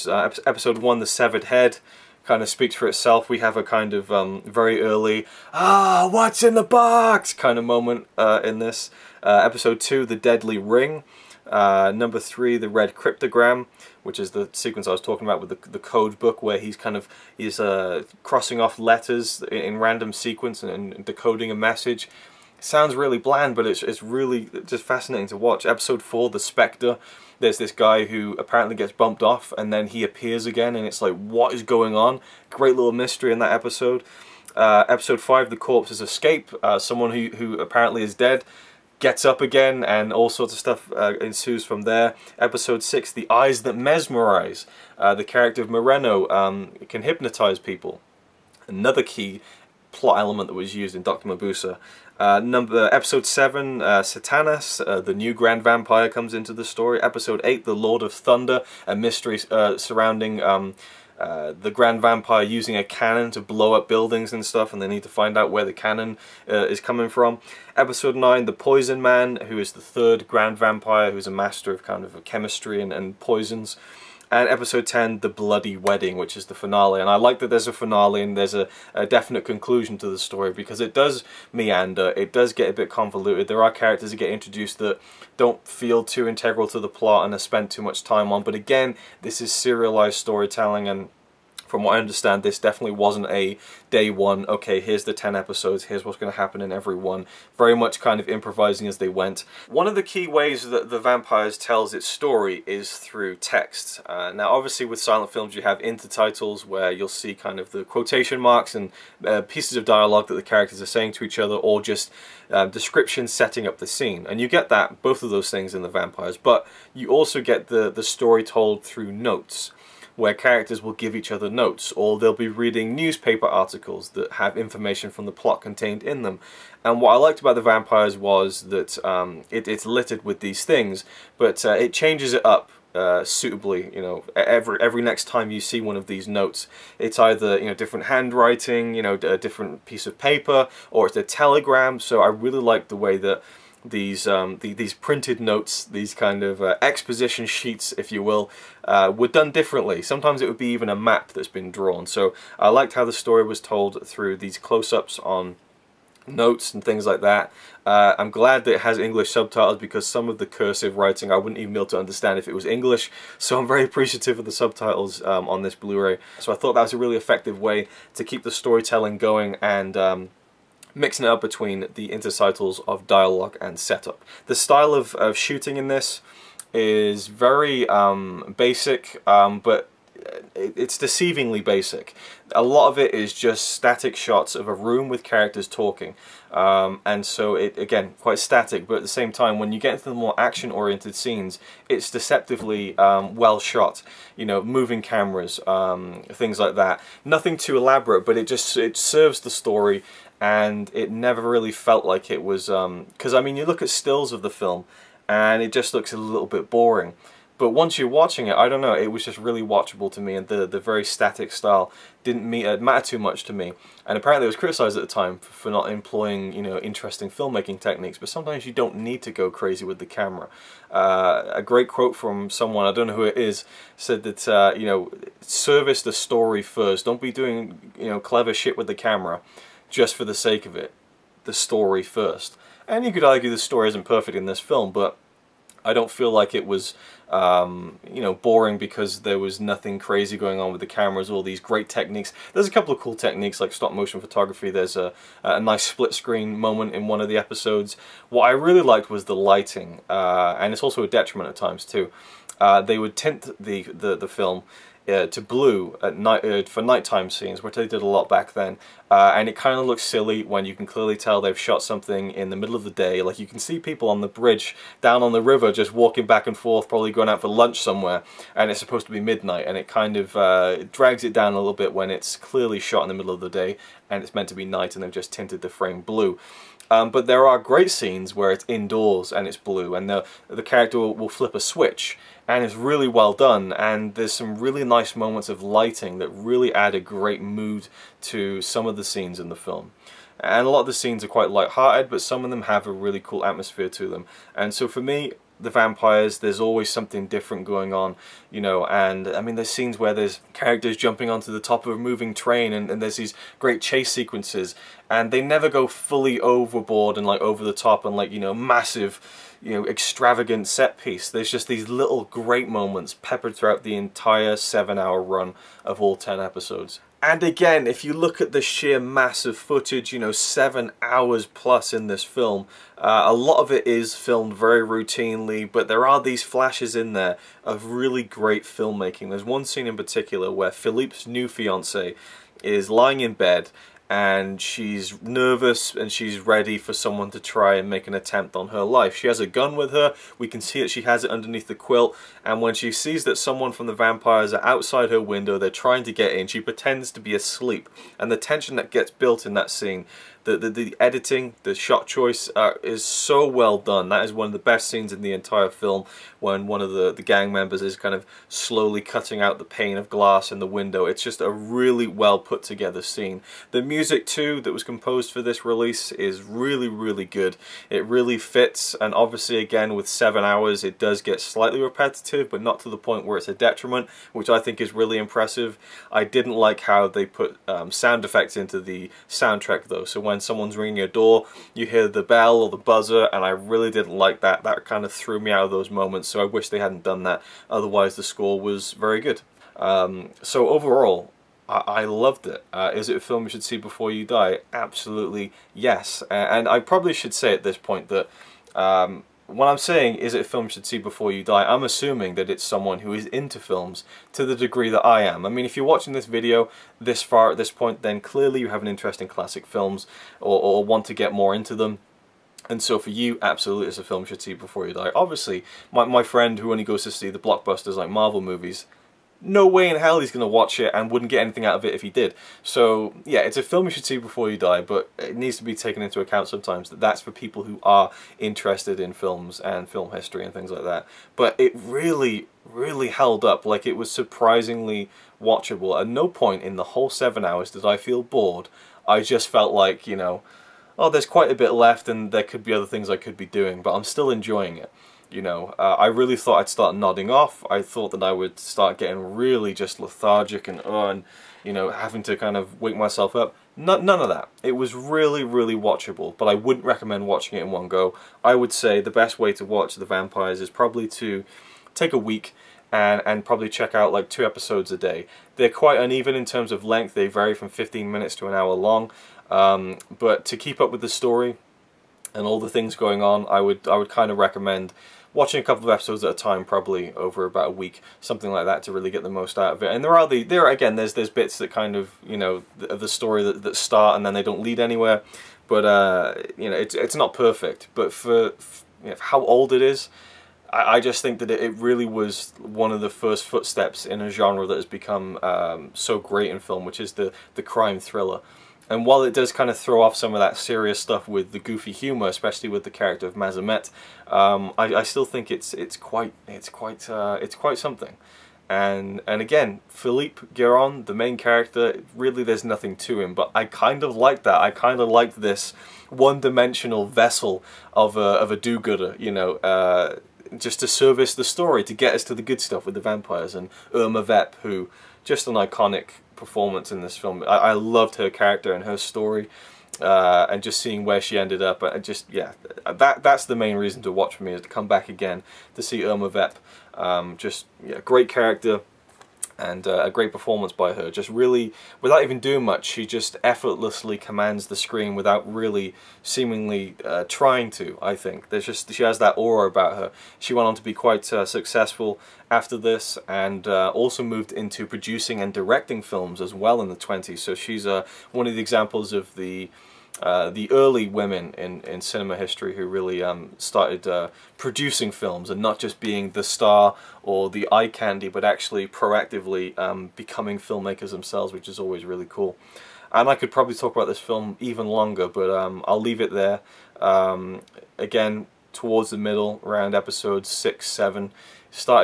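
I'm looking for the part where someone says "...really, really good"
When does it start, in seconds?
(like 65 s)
366 s.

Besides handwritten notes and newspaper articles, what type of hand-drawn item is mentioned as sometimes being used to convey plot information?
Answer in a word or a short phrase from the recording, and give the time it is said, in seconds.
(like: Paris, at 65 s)
A map, at 150 s.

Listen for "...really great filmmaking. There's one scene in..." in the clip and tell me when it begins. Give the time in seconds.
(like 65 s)
327 s.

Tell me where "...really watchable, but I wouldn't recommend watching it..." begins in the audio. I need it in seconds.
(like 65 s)
455 s.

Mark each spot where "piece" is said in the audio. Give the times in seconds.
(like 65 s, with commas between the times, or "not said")
109 s, 139 s, 311 s.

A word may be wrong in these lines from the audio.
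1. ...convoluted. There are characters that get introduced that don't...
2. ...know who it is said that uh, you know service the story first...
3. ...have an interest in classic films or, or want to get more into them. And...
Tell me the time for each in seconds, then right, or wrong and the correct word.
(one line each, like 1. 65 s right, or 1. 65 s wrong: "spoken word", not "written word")
1. 82 s right
2. 223 s right
3. 408 s right.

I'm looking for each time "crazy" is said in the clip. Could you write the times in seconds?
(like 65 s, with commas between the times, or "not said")
219 s, 239 s.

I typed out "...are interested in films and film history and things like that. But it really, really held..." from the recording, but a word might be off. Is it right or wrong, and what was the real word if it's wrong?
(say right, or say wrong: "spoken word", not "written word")
right.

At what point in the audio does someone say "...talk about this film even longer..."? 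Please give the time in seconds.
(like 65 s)
573 s.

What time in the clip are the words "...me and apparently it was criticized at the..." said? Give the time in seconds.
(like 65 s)
213 s.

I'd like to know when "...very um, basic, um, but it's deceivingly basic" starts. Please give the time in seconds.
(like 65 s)
177 s.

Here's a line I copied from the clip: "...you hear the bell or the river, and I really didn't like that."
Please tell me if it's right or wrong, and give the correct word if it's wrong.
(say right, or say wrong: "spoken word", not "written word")
wrong: "buzzer", not "river".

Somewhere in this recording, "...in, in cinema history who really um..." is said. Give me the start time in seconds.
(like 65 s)
561 s.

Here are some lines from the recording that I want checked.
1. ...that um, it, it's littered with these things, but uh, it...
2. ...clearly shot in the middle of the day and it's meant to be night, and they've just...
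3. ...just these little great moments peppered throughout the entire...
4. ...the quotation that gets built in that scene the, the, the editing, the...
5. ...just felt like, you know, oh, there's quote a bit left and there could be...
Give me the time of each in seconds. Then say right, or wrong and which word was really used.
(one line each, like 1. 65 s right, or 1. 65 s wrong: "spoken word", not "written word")
1. 128 s right
2. 272 s right
3. 311 s right
4. 348 s wrong: "tension", not "quotation"
5. 439 s wrong: "quite", not "quote".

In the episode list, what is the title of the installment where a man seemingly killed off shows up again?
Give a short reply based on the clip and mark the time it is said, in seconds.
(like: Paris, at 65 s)
The Spectre, at 26 s.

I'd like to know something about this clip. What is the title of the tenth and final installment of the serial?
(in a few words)
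The Bloody Wedding.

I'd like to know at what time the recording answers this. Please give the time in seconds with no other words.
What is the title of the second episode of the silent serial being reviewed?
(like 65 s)
10 s.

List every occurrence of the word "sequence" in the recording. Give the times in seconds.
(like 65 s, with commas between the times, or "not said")
14 s, 20 s, 304 s.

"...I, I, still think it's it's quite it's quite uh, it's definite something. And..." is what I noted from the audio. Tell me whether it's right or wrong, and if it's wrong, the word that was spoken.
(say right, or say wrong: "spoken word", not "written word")
wrong: "quite", not "definite".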